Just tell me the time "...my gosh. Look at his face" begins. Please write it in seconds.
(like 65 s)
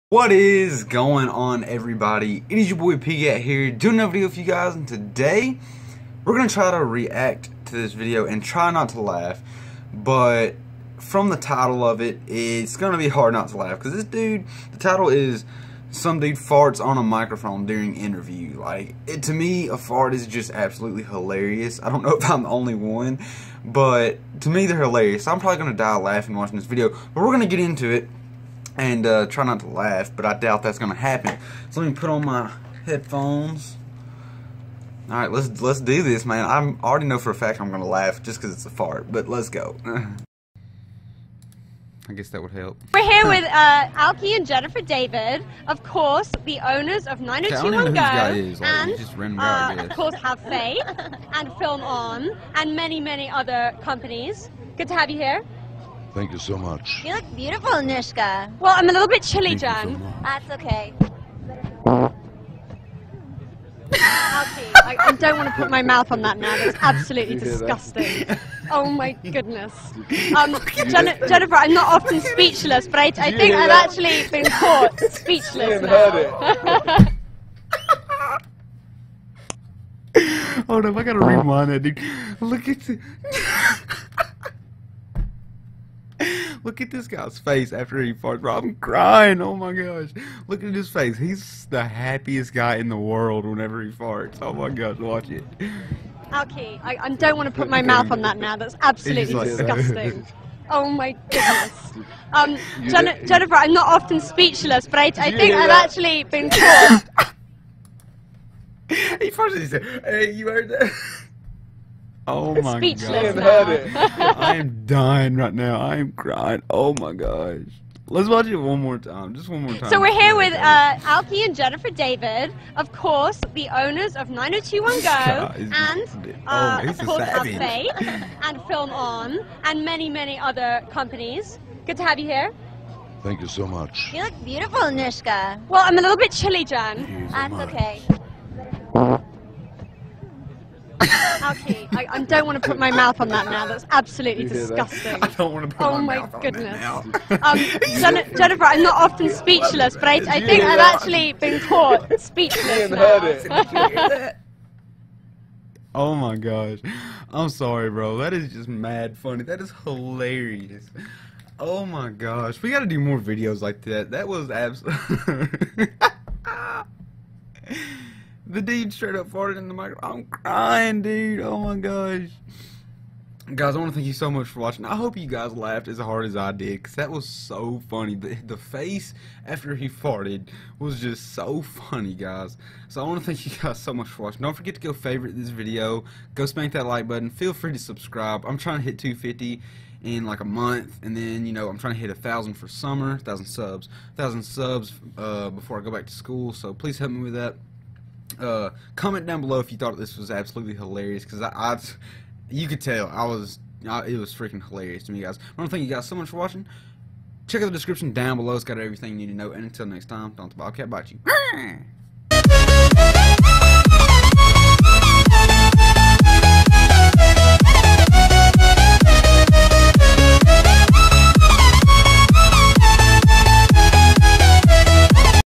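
89 s.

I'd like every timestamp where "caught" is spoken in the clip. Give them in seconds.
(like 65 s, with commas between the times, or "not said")
74 s, 151 s.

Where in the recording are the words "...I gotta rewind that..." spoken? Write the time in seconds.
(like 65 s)
80 s.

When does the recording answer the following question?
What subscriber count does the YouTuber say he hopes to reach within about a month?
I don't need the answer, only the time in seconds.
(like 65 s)
188 s.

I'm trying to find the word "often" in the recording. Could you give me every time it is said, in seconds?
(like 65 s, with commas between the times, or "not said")
71 s, 103 s, 149 s.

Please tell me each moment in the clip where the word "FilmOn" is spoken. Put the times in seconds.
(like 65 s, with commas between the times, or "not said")
51 s, 128 s.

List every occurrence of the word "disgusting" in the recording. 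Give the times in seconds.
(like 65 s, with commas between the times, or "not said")
67 s, 99 s, 144 s.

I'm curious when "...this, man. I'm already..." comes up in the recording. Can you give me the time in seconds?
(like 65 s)
36 s.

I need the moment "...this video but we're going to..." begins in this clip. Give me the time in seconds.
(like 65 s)
26 s.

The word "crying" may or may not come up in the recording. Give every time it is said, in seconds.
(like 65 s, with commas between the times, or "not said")
88 s, 116 s, 170 s.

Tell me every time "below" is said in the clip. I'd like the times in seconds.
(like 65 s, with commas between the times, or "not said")
199 s, 208 s.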